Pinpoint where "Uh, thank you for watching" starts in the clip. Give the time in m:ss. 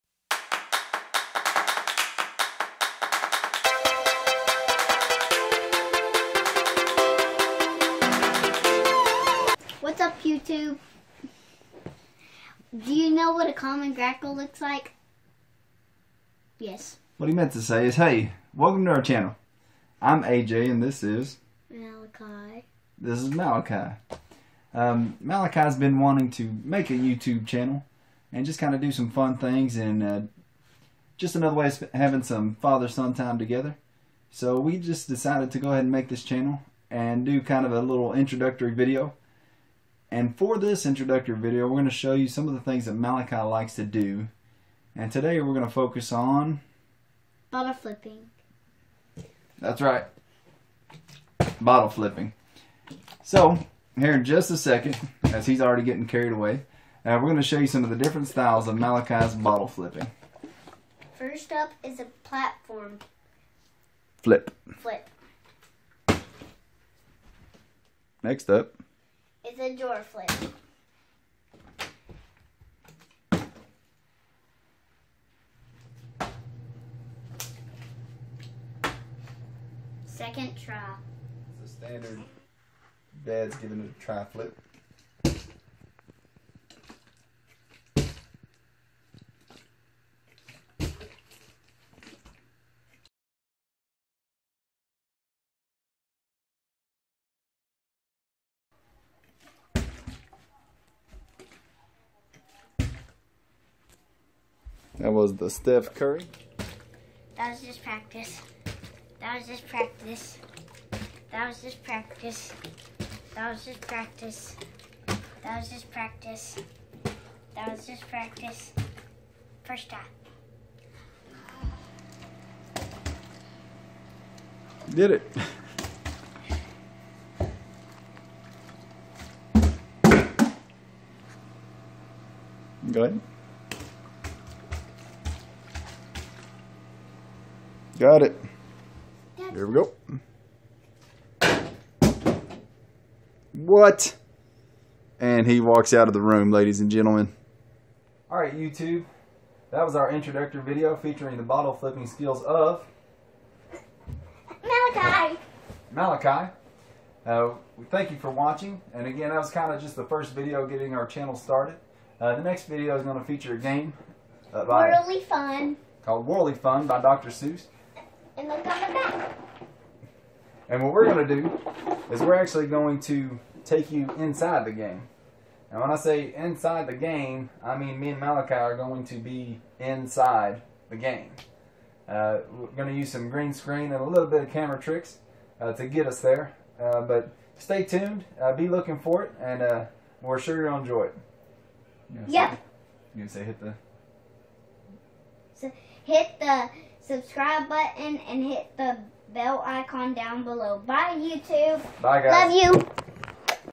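2:37.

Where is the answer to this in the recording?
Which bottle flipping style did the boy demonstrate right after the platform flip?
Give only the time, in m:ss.
1:09.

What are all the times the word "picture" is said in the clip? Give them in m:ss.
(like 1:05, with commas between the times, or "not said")
not said.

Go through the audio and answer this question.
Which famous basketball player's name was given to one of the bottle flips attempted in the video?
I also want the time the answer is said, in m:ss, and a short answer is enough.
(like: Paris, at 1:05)
Steph Curry, at 1:45.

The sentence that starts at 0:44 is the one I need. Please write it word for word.
And today we're going to focus on...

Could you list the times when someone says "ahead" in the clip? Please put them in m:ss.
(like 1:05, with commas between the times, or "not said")
0:35, 2:13.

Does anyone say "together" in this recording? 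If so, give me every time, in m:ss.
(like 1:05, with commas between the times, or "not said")
0:33.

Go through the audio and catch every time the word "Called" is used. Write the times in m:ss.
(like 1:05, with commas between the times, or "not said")
2:46.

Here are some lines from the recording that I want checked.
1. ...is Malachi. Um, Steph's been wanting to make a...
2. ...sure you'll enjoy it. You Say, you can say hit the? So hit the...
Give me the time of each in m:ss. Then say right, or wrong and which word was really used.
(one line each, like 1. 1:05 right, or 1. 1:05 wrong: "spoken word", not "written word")
1. 0:23 wrong: "Malachi", not "Steph"
2. 3:10 right.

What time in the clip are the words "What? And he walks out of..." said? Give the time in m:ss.
2:23.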